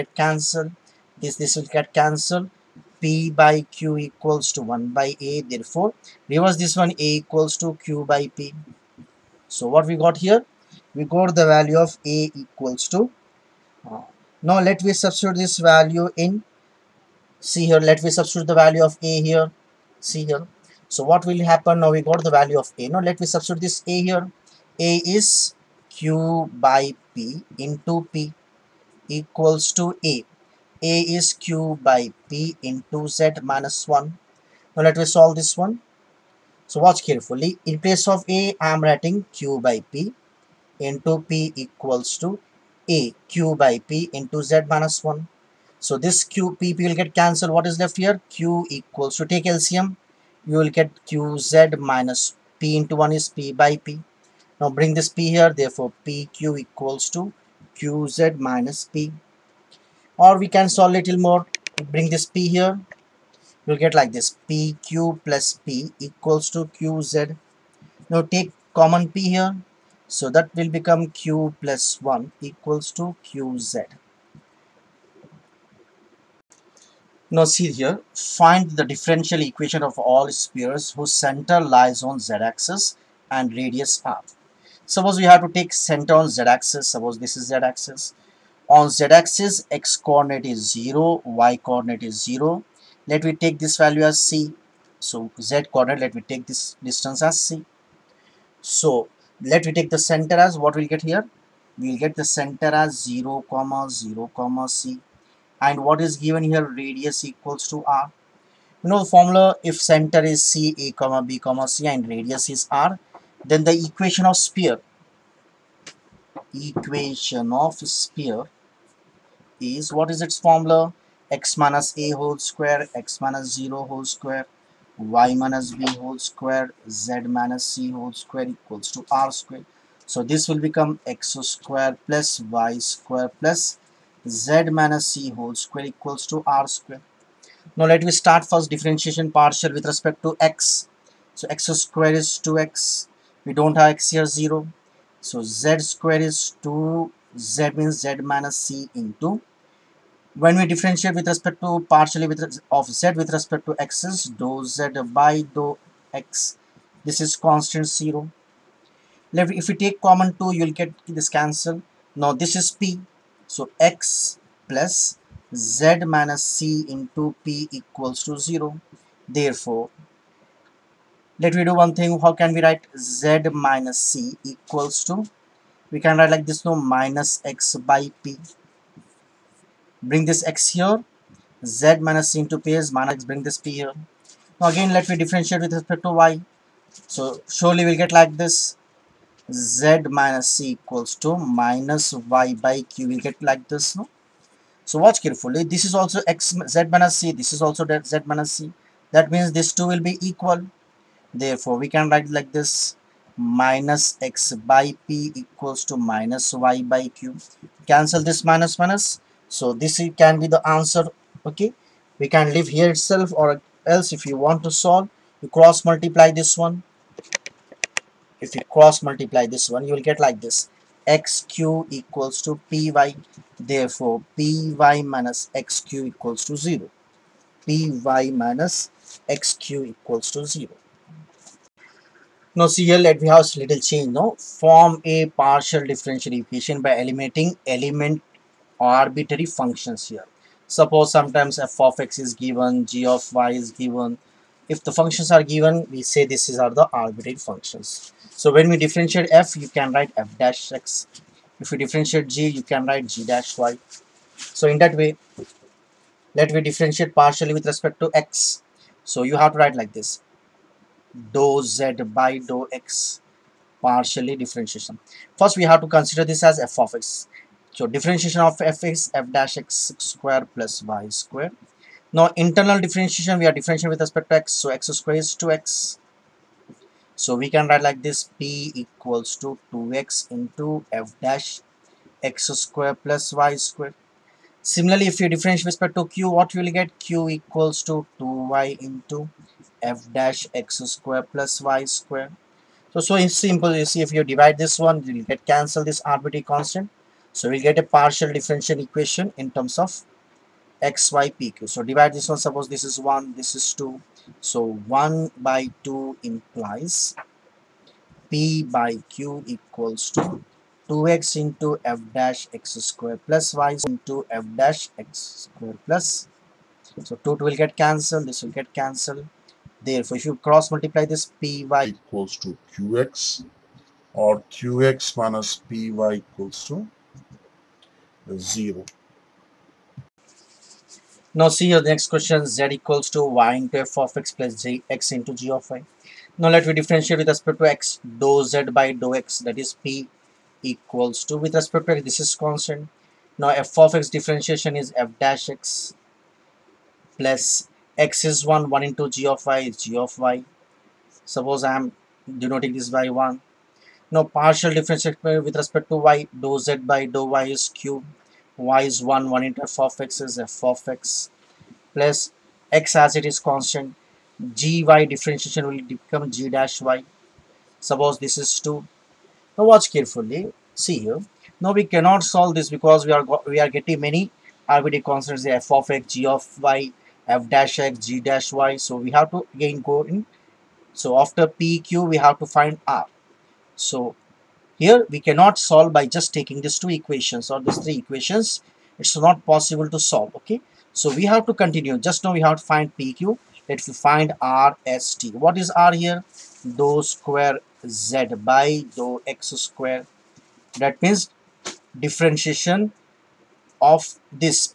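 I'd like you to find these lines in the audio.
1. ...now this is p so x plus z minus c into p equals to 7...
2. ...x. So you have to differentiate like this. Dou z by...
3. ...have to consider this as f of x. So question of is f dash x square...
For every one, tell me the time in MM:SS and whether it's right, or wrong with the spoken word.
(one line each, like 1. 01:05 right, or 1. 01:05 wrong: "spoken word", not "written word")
1. 02:42 wrong: "0", not "7"
2. 04:18 wrong: "write", not "differentiate"
3. 04:25 wrong: "differentiation", not "question".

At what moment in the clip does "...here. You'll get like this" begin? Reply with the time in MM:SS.
01:02.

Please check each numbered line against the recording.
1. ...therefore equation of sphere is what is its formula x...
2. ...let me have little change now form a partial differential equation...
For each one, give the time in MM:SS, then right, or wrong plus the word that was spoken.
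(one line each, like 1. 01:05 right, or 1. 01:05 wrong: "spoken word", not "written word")
1. 01:54 wrong: "sphere", not "therefore"
2. 03:52 right.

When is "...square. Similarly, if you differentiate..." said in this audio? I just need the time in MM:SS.
04:43.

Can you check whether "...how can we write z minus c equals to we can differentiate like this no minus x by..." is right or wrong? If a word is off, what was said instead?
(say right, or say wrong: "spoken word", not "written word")
wrong: "write", not "differentiate".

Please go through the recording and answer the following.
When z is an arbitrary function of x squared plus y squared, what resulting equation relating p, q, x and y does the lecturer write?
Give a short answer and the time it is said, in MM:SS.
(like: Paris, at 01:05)
qx - py = 0, at 05:24.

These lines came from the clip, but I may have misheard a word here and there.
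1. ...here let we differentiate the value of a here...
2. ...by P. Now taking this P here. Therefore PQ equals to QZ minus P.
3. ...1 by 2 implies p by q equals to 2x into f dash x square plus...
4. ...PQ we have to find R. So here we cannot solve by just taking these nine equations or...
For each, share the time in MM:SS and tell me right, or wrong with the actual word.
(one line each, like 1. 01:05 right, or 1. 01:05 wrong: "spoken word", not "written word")
1. 00:17 wrong: "substitute", not "differentiate"
2. 00:53 wrong: "bring", not "taking"
3. 05:04 right
4. 06:21 wrong: "two", not "nine".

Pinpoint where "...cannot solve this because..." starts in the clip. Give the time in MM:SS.
06:11.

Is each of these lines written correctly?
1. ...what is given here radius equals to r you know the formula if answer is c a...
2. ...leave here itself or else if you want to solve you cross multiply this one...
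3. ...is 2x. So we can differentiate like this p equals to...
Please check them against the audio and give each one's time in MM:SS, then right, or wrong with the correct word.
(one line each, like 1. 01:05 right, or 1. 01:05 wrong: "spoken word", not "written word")
1. 01:45 wrong: "center", not "answer"
2. 03:32 right
3. 04:35 wrong: "write", not "differentiate".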